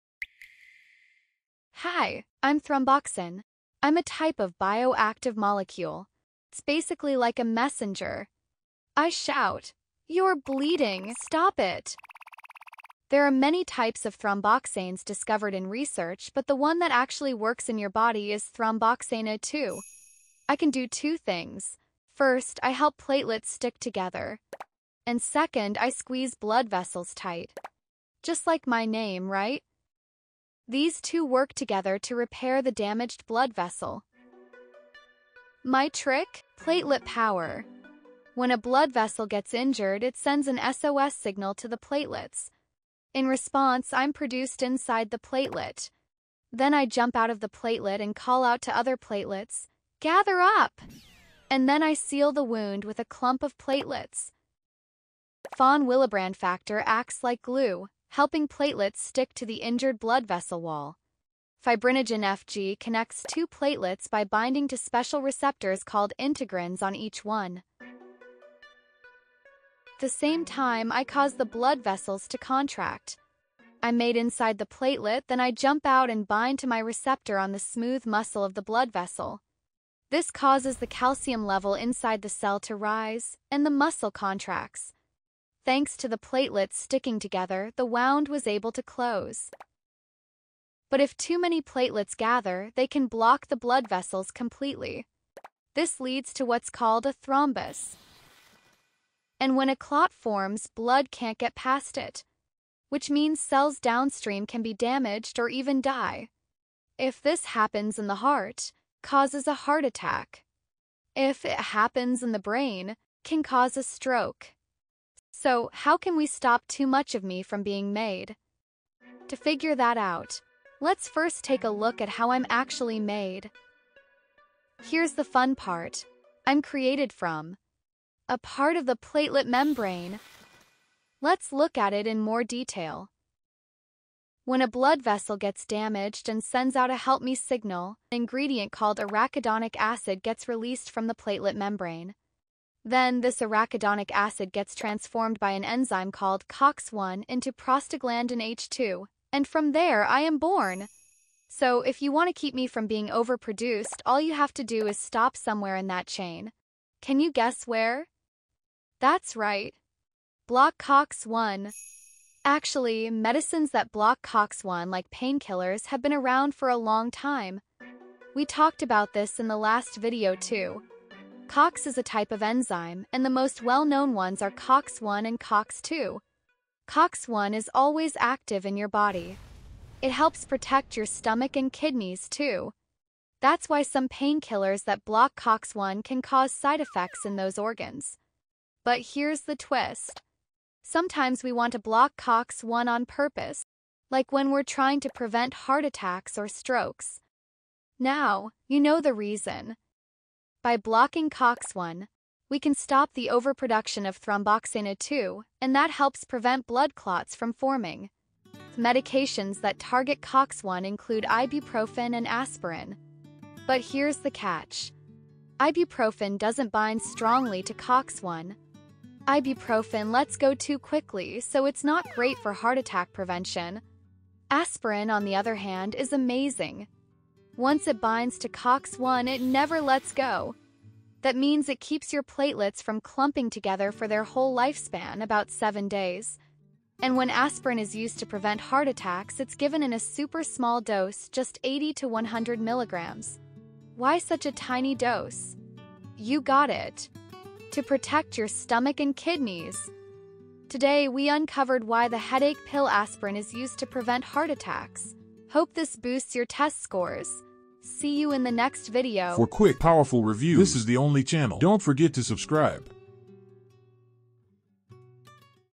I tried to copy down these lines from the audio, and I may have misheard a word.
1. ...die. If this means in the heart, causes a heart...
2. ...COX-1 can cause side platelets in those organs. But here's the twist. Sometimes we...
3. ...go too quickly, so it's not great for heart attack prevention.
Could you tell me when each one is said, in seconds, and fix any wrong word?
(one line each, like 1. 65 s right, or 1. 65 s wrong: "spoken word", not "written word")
1. 105 s wrong: "happens", not "means"
2. 185 s wrong: "effects", not "platelets"
3. 220 s right.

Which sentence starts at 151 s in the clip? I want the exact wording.
So if you want to keep me from being overproduced, all you have to do is stop somewhere in that chain.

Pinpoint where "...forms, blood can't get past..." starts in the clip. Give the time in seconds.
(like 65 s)
100 s.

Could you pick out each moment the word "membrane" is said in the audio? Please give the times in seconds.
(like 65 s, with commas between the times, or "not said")
129 s, 141 s.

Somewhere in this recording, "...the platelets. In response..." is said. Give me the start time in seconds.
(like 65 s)
41 s.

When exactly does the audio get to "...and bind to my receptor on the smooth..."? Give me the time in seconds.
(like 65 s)
76 s.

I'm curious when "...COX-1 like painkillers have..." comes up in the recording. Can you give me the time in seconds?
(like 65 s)
164 s.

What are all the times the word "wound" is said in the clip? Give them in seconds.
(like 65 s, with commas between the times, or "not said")
52 s, 87 s.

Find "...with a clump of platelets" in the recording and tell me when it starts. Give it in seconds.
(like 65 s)
52 s.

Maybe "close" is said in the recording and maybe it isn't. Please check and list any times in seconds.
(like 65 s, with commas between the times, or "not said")
88 s.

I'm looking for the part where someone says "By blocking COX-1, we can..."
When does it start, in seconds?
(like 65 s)
200 s.